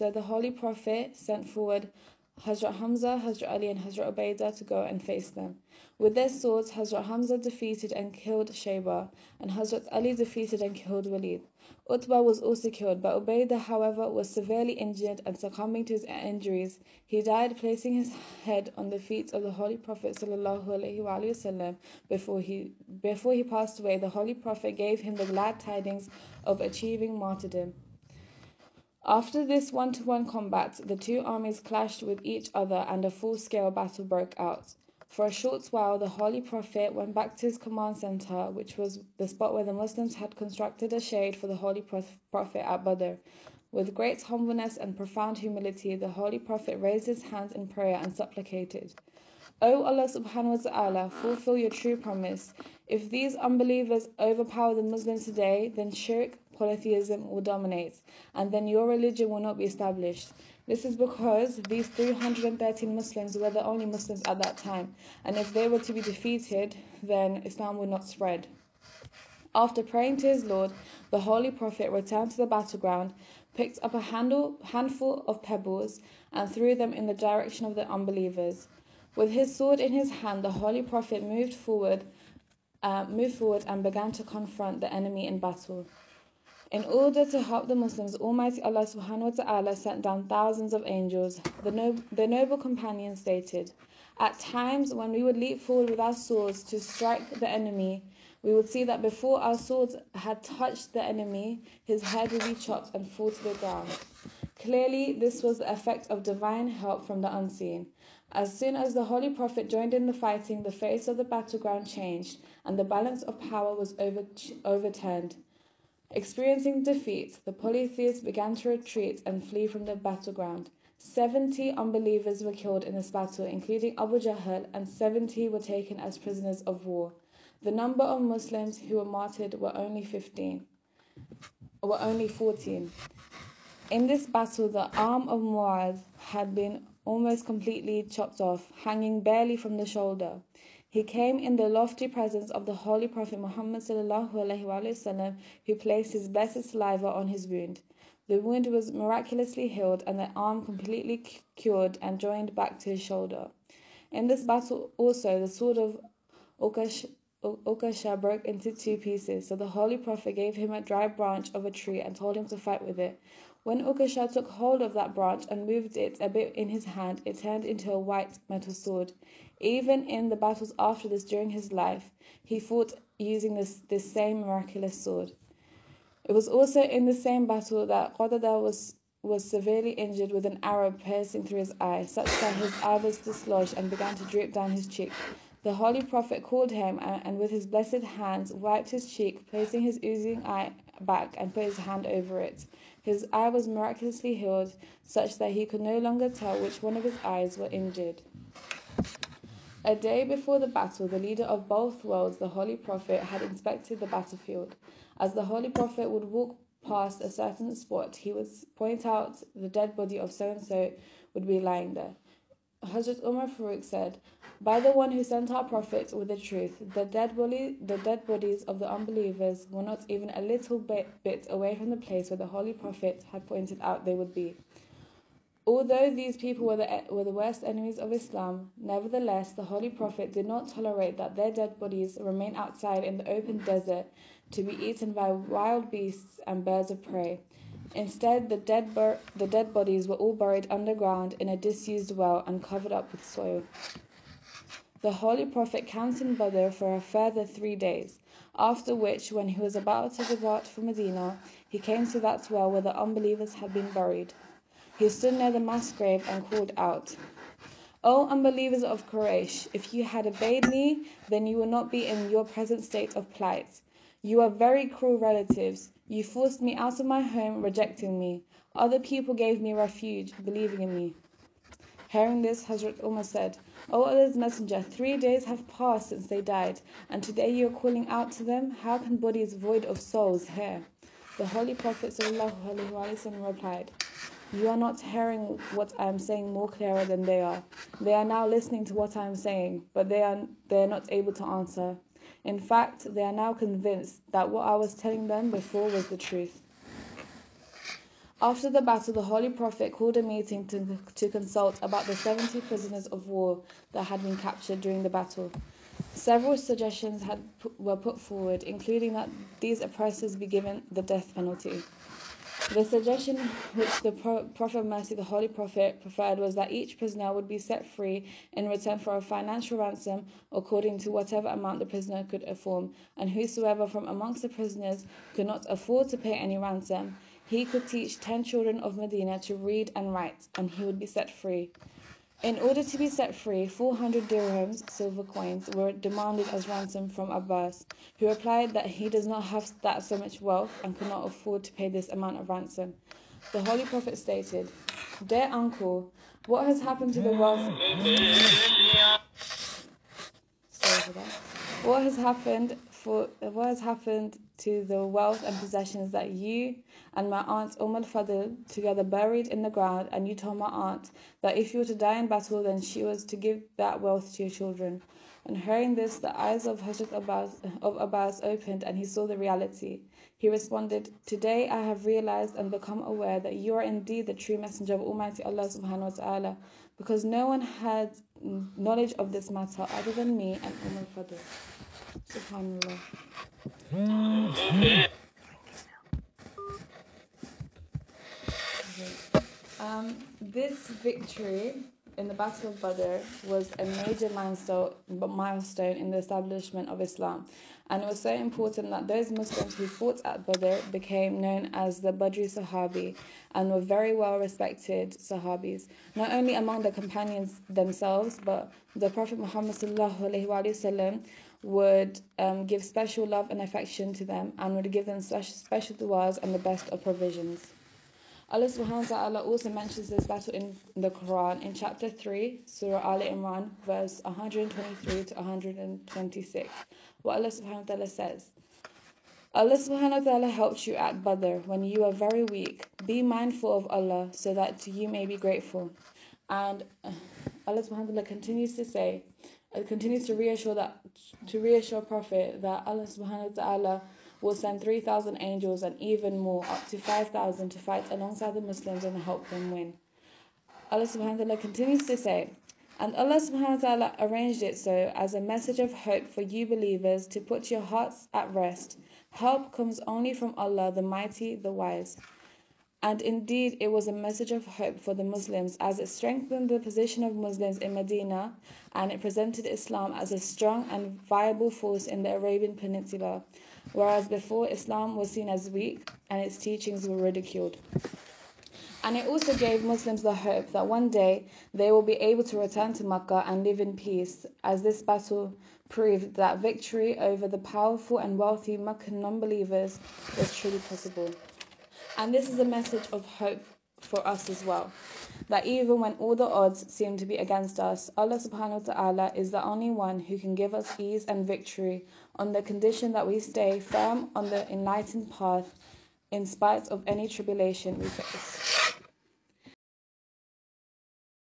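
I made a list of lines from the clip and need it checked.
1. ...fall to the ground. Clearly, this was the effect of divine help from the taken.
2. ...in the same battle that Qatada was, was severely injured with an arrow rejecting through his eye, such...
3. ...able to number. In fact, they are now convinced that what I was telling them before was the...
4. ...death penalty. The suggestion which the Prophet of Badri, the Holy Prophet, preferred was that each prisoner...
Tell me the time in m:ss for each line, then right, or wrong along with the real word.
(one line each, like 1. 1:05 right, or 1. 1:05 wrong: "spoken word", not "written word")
1. 1:43 wrong: "unseen", not "taken"
2. 2:56 wrong: "piercing", not "rejecting"
3. 4:51 wrong: "answer", not "number"
4. 5:11 wrong: "Mercy", not "Badri".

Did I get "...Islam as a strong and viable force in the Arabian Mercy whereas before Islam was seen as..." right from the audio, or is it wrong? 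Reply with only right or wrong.
wrong.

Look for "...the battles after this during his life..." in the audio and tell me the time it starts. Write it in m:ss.
2:50.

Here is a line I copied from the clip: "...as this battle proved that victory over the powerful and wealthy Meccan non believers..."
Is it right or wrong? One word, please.
right.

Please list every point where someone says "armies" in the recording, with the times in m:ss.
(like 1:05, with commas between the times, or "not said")
0:31.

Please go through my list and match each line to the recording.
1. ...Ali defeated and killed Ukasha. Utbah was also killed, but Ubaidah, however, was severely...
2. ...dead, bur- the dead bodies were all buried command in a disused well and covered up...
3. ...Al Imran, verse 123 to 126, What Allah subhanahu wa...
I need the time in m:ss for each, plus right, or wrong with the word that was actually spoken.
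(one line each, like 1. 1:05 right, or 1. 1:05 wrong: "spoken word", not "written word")
1. 0:09 wrong: "Walid", not "Ukasha"
2. 3:58 wrong: "underground", not "command"
3. 7:03 right.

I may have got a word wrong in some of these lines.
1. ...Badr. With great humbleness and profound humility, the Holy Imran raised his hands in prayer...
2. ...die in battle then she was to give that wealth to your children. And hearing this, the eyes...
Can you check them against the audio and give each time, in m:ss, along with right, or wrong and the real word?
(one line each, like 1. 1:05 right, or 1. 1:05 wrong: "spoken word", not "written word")
1. 0:42 wrong: "Prophet", not "Imran"
2. 6:01 right.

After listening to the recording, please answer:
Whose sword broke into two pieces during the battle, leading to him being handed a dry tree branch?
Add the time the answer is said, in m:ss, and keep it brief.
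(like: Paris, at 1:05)
Ukash, at 2:36.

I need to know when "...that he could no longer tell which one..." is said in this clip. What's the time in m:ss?
3:15.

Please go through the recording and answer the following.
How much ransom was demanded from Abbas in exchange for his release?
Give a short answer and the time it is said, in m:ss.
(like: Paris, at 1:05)
400 dirhams, at 5:33.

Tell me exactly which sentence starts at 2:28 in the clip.
The wound was miraculously healed and the arm completely cured and joined back to his shoulder.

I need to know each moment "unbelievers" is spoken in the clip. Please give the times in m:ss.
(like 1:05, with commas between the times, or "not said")
0:53, 1:17, 2:01, 3:38, 4:12, 4:18.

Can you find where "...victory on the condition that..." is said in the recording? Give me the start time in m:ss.
8:21.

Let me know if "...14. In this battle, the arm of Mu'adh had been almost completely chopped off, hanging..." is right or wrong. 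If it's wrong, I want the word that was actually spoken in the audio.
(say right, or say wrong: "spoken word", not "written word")
right.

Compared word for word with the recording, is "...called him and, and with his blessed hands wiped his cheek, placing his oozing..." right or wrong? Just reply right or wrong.
right.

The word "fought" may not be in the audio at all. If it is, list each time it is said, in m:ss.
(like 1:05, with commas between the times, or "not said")
2:52, 6:39.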